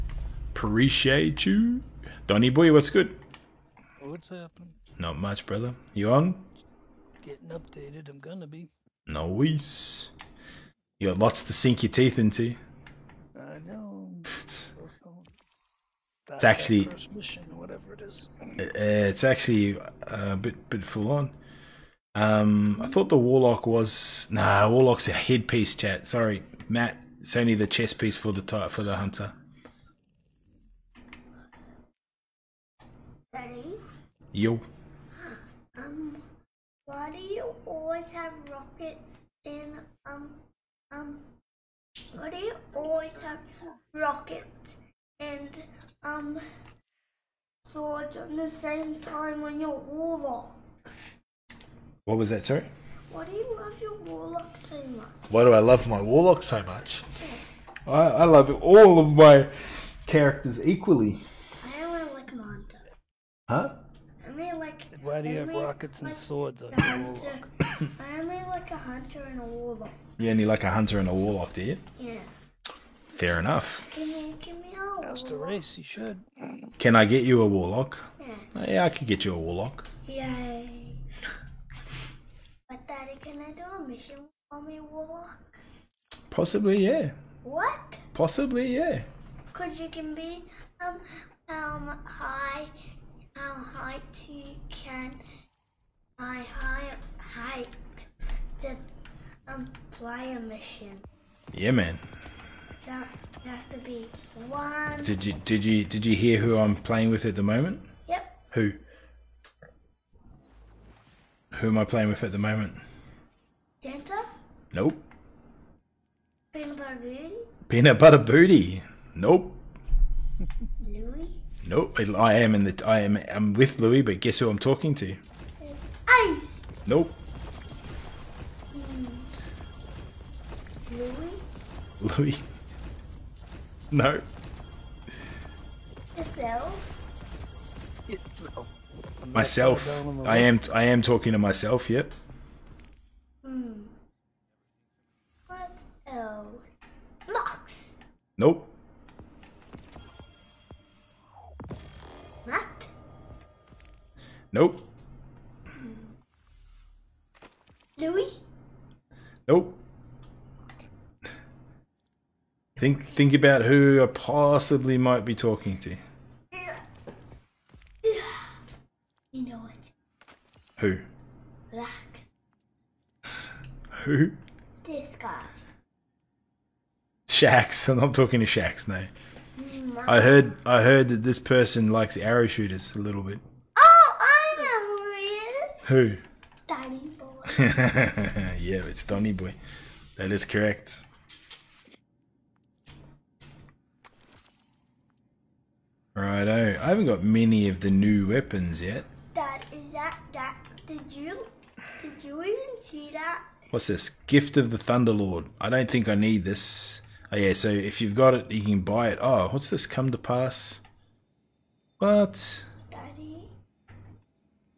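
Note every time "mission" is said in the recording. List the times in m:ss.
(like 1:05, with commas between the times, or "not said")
0:17, 1:23, 1:40.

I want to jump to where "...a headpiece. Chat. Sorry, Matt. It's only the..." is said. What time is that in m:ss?
0:25.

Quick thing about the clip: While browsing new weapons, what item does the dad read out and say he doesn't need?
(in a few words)
Gift of the Thunderlord.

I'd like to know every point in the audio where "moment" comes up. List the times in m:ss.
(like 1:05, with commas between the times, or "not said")
1:47, 1:52.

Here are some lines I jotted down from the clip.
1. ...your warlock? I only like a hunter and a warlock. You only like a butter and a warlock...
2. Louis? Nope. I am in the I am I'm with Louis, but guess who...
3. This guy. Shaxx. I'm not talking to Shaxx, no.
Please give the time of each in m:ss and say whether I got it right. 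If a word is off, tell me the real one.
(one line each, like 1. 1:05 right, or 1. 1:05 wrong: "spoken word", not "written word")
1. 1:06 wrong: "hunter", not "butter"
2. 2:00 right
3. 2:54 right.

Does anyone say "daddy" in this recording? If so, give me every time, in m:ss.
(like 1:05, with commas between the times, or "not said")
1:22, 3:32.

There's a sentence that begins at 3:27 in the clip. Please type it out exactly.
Oh yeah, so if you've got it, you can buy it.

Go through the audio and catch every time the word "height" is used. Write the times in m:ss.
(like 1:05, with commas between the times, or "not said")
1:37.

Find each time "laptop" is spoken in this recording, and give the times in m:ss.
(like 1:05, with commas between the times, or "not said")
not said.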